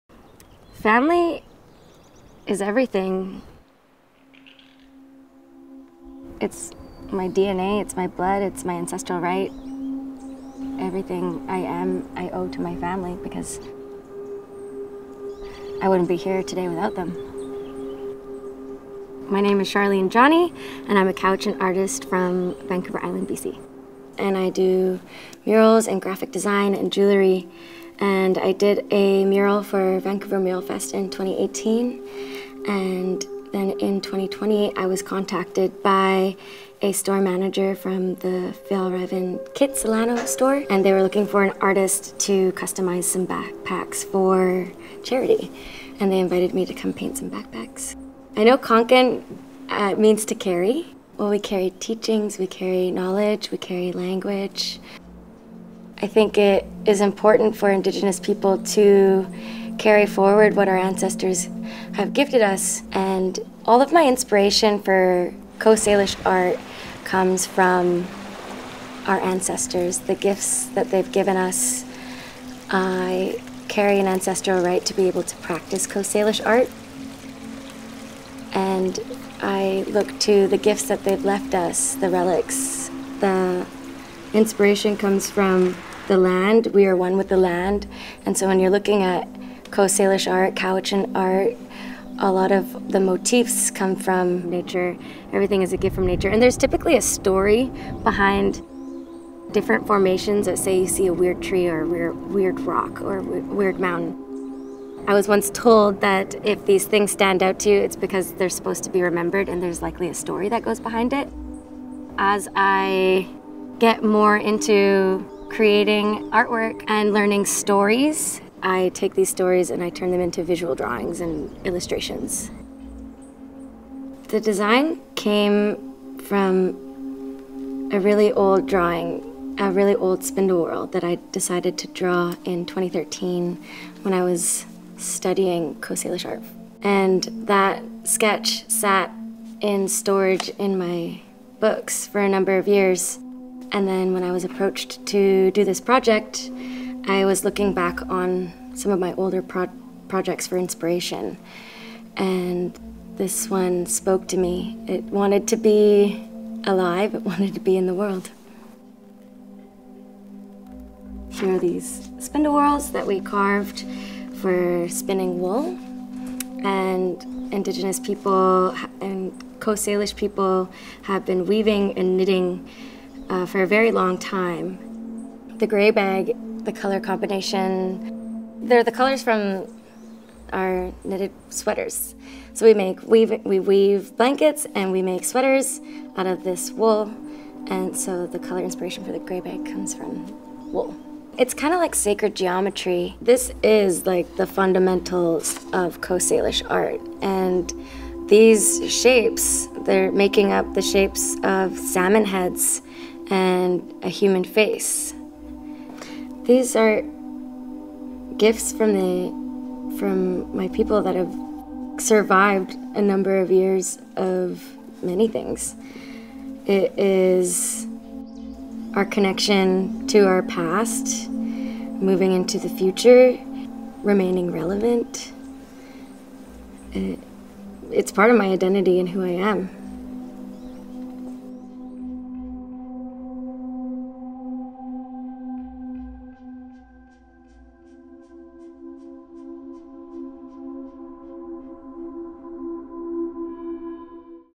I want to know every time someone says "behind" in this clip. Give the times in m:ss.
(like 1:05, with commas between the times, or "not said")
1:38, 1:50.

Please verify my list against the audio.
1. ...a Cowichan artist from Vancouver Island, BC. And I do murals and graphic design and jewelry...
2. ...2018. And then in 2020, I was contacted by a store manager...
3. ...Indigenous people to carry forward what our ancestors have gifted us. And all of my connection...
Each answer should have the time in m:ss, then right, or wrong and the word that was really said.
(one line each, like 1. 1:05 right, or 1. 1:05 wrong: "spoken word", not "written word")
1. 0:21 right
2. 0:31 right
3. 0:57 wrong: "inspiration", not "connection".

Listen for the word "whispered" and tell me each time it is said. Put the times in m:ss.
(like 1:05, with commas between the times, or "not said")
not said.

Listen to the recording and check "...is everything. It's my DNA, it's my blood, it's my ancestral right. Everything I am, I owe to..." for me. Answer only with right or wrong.
right.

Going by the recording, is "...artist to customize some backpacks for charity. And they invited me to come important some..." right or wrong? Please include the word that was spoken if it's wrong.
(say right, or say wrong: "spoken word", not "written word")
wrong: "paint", not "important".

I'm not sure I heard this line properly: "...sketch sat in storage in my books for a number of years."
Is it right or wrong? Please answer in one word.
right.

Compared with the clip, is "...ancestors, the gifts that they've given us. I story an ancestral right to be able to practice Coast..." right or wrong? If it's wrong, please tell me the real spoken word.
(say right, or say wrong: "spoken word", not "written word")
wrong: "carry", not "story".